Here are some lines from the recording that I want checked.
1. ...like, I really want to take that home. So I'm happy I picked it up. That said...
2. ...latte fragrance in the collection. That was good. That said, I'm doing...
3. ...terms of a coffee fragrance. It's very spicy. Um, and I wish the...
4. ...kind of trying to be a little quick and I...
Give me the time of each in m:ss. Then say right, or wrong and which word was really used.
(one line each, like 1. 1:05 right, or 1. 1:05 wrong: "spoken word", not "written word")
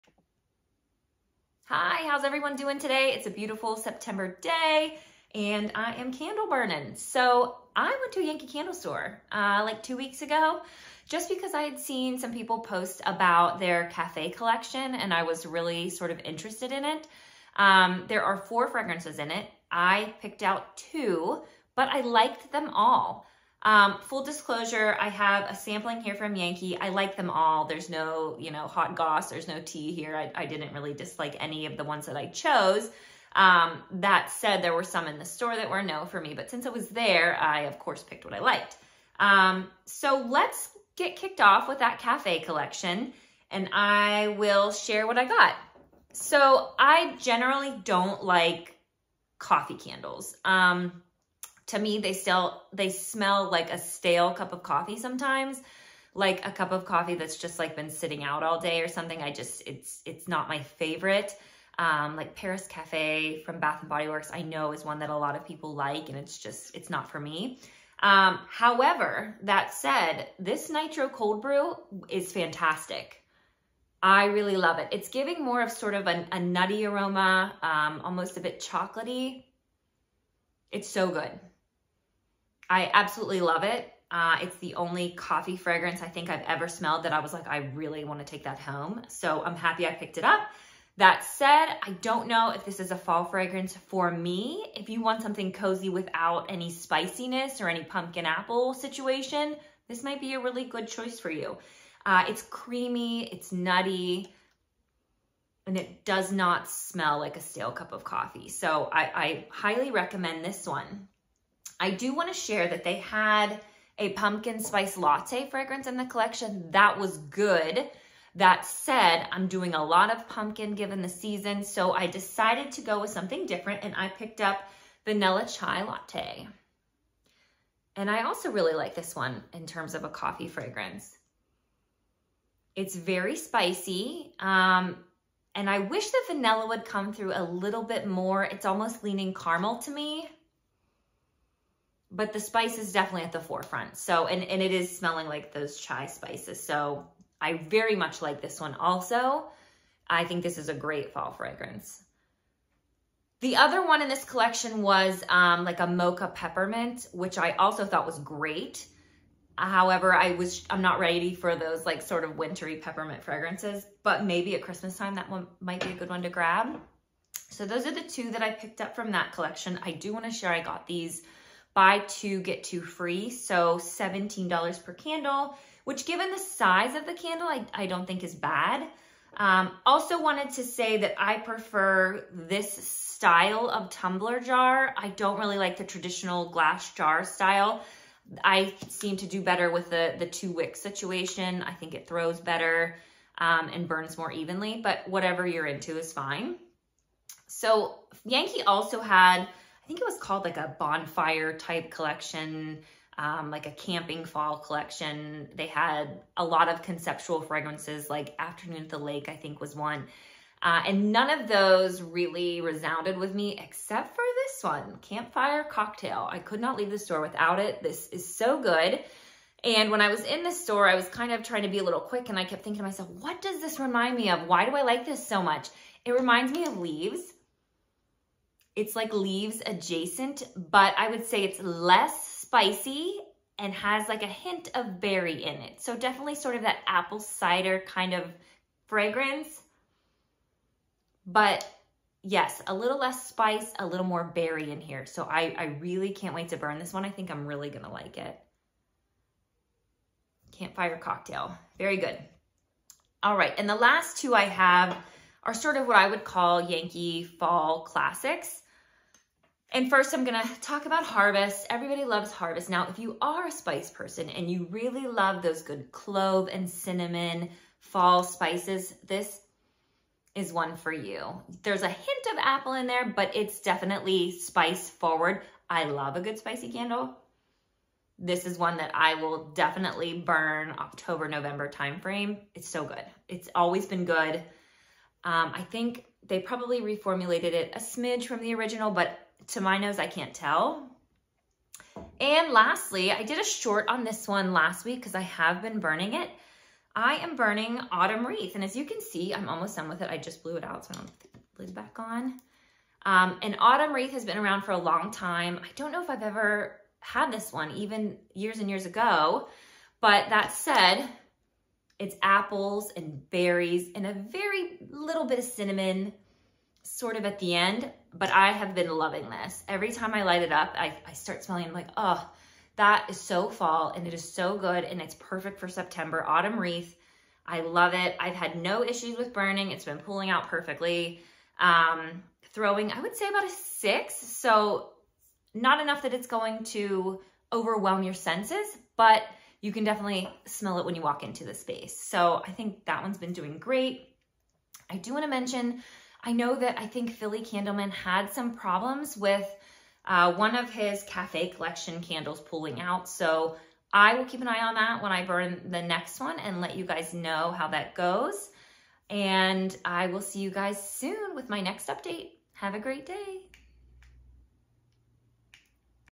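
1. 1:27 right
2. 1:54 right
3. 2:09 right
4. 3:41 right.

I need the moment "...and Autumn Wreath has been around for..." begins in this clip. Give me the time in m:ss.
5:03.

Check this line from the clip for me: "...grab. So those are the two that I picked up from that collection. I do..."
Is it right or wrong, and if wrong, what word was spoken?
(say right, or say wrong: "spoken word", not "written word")
right.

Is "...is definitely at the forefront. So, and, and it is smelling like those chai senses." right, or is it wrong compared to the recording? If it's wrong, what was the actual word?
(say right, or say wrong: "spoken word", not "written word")
wrong: "spices", not "senses".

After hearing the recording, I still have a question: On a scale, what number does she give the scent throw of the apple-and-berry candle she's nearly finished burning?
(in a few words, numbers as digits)
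6.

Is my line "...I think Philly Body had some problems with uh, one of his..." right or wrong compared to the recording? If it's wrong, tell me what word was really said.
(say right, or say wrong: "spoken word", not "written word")
wrong: "Candleman", not "Body".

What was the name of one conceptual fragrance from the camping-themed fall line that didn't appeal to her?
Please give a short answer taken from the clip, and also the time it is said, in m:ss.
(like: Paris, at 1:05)
Afternoon at the Lake, at 3:28.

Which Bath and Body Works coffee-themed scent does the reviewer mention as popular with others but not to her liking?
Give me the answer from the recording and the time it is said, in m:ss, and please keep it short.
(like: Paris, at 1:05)
Paris Cafe, at 1:02.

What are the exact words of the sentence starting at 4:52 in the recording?
And lastly, I did a short on this one last week because I have been burning it.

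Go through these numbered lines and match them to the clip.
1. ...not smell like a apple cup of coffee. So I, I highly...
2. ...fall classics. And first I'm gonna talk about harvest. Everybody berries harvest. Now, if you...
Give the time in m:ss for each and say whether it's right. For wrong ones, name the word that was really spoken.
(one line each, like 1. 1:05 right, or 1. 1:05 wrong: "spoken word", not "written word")
1. 1:46 wrong: "stale", not "apple"
2. 4:17 wrong: "loves", not "berries".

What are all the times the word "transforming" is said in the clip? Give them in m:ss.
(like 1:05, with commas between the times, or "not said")
not said.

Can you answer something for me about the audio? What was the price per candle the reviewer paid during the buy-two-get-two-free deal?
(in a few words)
$17.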